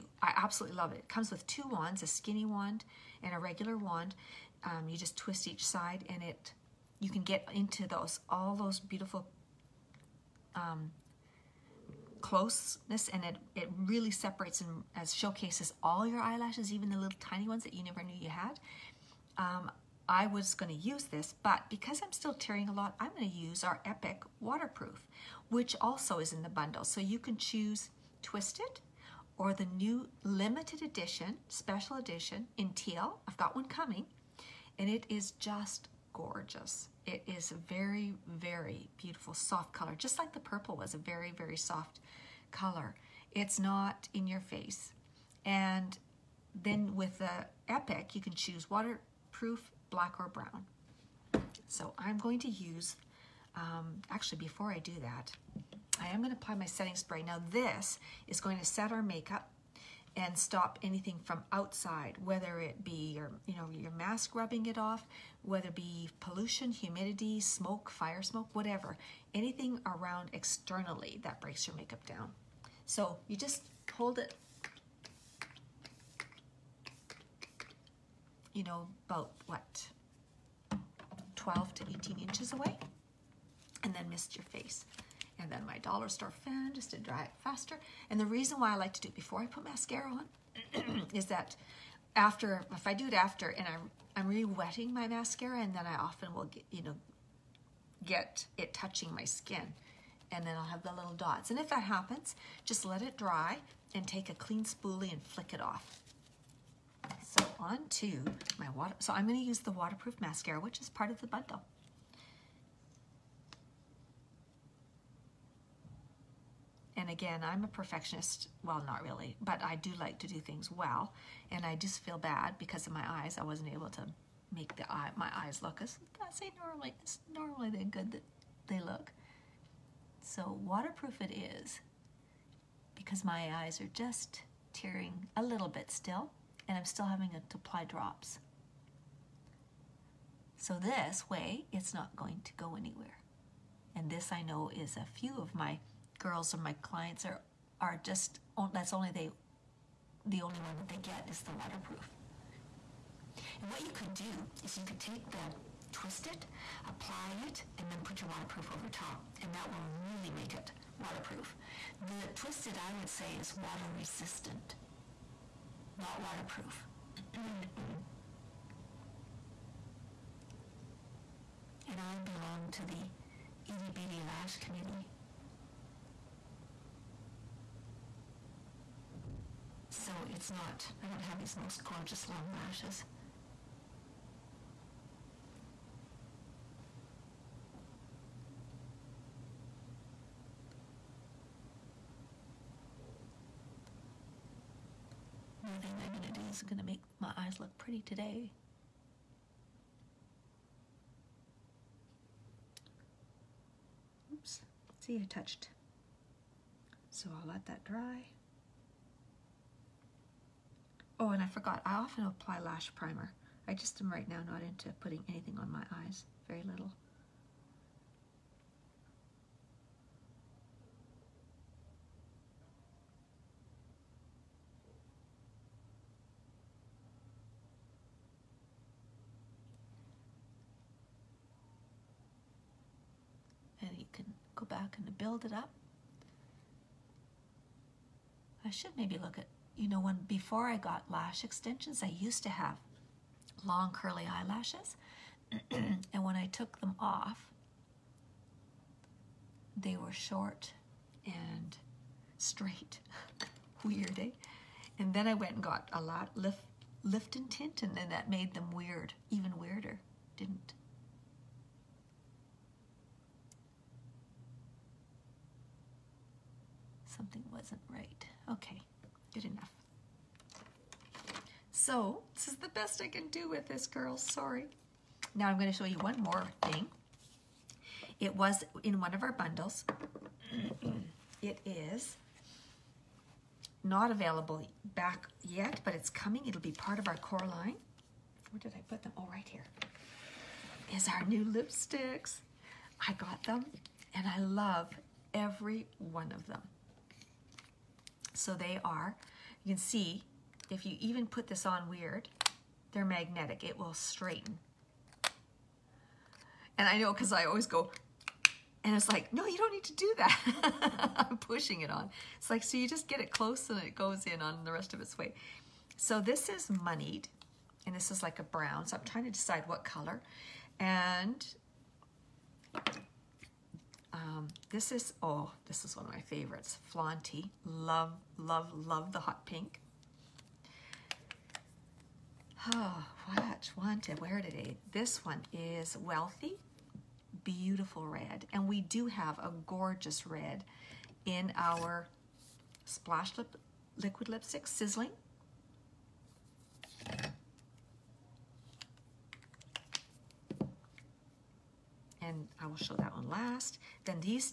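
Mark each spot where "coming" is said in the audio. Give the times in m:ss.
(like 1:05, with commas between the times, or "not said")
0:33, 4:46.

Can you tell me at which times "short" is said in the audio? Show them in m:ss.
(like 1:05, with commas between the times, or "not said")
4:10.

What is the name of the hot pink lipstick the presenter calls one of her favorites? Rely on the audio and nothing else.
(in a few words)
Flaunty.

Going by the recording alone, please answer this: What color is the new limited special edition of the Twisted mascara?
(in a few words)
Teal.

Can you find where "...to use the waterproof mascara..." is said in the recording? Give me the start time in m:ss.
1:49.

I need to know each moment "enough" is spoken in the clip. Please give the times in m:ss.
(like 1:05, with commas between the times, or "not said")
4:29.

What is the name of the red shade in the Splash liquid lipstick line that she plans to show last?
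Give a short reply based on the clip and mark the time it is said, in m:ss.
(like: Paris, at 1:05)
Sizzling, at 5:44.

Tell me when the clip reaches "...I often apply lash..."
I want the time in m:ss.
3:31.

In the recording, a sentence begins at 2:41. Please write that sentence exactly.
The twisted, I would say, is water resistant, not waterproof.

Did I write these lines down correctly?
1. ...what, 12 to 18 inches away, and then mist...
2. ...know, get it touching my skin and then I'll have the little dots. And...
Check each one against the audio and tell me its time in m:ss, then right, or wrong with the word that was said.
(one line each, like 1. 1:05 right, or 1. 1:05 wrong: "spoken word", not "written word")
1. 1:19 right
2. 1:36 right.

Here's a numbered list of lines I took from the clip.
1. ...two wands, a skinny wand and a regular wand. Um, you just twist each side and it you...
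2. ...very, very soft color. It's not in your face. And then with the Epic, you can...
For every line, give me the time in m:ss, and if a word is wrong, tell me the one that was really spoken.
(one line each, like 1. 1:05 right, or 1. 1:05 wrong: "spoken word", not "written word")
1. 0:01 right
2. 0:40 right.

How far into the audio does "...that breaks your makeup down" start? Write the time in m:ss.
1:11.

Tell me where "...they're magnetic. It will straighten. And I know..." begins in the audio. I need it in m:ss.
5:02.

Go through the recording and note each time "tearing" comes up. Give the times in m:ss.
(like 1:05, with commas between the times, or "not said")
0:22, 2:14.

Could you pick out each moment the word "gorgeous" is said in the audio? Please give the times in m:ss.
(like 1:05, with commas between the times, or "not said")
0:36, 3:01, 5:39.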